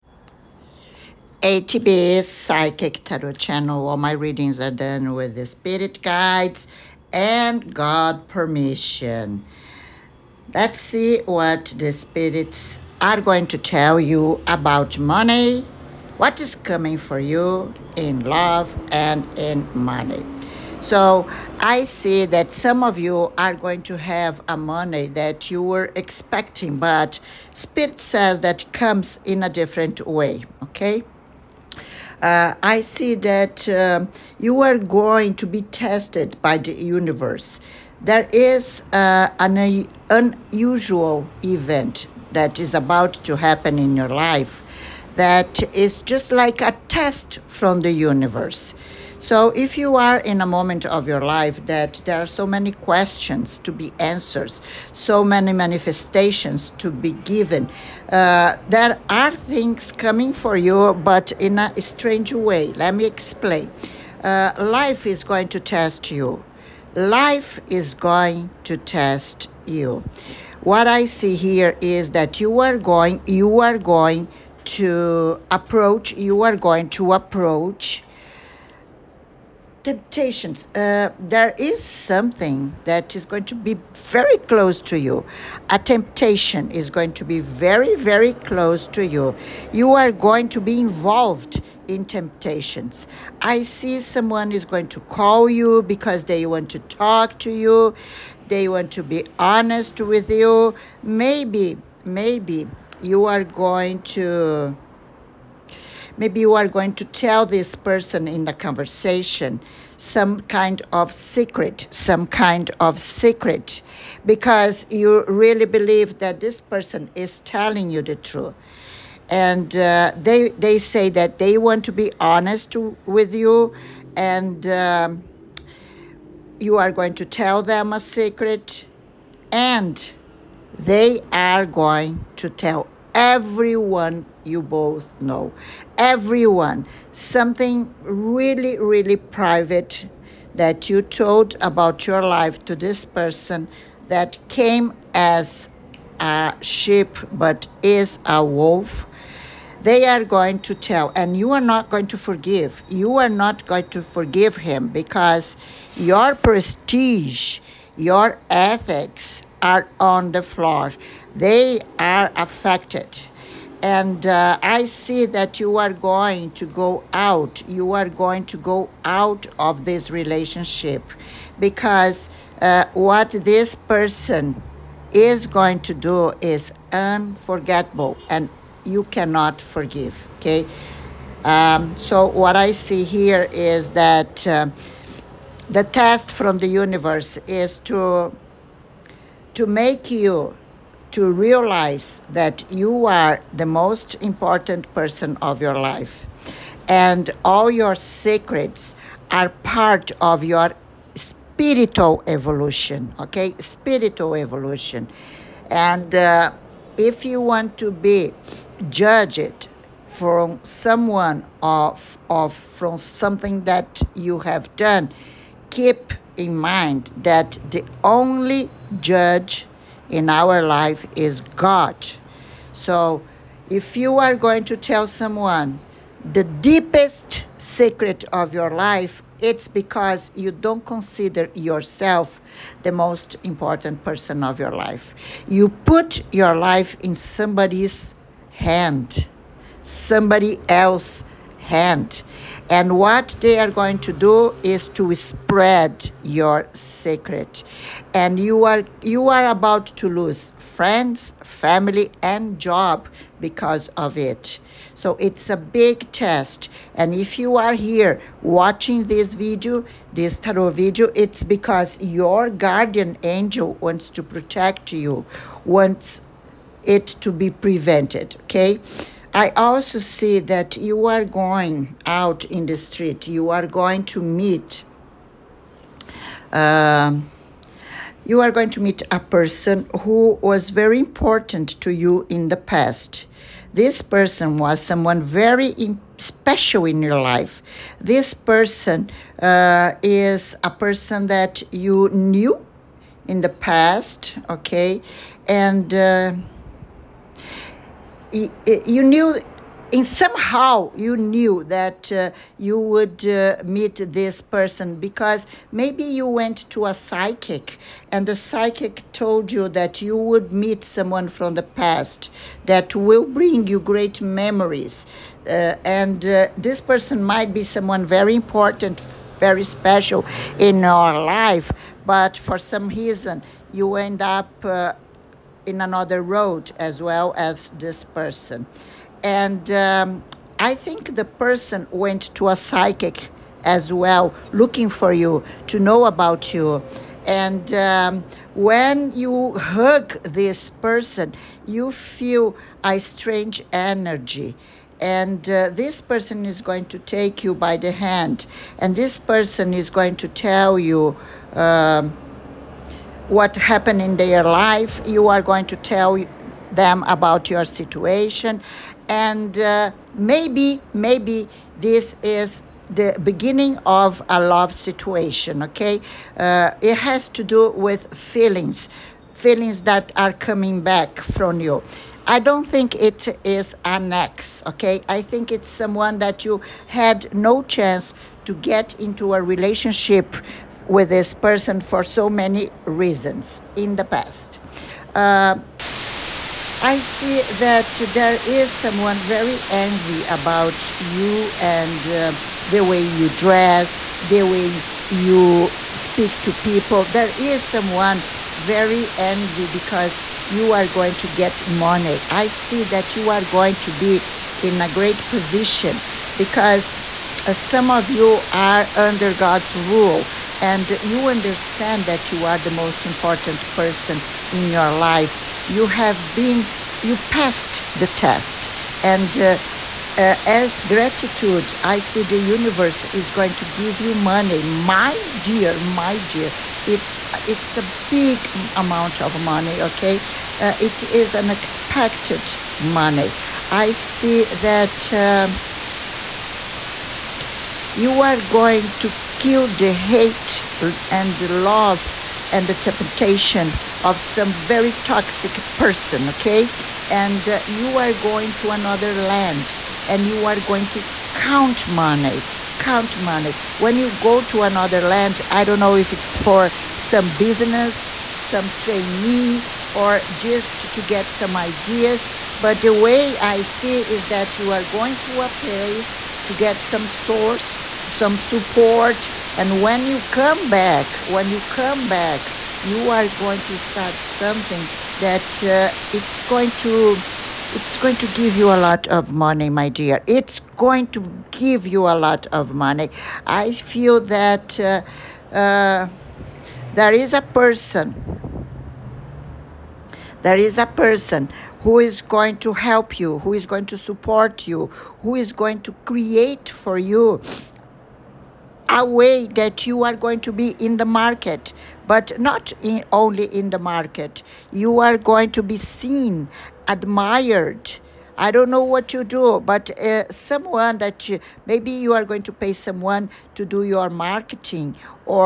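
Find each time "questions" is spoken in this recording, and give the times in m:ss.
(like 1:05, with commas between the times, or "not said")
0:52.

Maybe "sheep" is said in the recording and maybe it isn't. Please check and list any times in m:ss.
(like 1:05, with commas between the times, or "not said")
2:26.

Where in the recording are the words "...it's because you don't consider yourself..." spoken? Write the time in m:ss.
3:49.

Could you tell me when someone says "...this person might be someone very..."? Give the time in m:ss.
5:16.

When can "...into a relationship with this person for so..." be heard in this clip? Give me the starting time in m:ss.
6:18.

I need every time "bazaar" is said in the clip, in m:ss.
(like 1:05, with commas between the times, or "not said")
not said.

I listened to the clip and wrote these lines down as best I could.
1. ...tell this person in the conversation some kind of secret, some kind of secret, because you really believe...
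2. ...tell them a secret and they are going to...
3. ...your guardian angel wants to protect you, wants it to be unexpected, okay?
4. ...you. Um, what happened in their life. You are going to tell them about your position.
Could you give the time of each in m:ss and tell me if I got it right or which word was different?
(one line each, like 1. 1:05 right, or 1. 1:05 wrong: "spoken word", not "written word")
1. 1:47 right
2. 2:07 right
3. 4:22 wrong: "prevented", not "unexpected"
4. 5:50 wrong: "situation", not "position".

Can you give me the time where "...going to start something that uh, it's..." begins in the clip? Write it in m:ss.
7:53.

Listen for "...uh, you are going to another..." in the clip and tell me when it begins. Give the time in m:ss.
7:27.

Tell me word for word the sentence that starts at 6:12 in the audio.
I don't think it is an ex, okay?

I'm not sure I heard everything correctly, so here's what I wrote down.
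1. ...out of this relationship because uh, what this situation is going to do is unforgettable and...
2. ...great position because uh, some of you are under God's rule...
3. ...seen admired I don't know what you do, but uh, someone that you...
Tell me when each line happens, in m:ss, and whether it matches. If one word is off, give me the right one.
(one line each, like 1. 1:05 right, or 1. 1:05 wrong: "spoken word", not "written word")
1. 2:49 wrong: "person", not "situation"
2. 6:44 right
3. 8:25 right.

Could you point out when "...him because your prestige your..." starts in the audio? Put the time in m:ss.
2:34.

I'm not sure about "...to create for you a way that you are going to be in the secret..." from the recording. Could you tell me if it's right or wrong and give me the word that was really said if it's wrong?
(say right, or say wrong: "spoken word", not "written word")
wrong: "market", not "secret".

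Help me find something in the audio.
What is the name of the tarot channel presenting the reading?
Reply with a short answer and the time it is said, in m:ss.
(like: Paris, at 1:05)
ATB Psychic Tarot Channel, at 0:01.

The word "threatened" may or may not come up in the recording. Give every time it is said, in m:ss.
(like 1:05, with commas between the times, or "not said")
not said.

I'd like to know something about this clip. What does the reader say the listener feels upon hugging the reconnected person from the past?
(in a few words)
a strange energy.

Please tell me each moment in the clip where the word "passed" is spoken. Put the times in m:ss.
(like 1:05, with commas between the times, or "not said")
6:57.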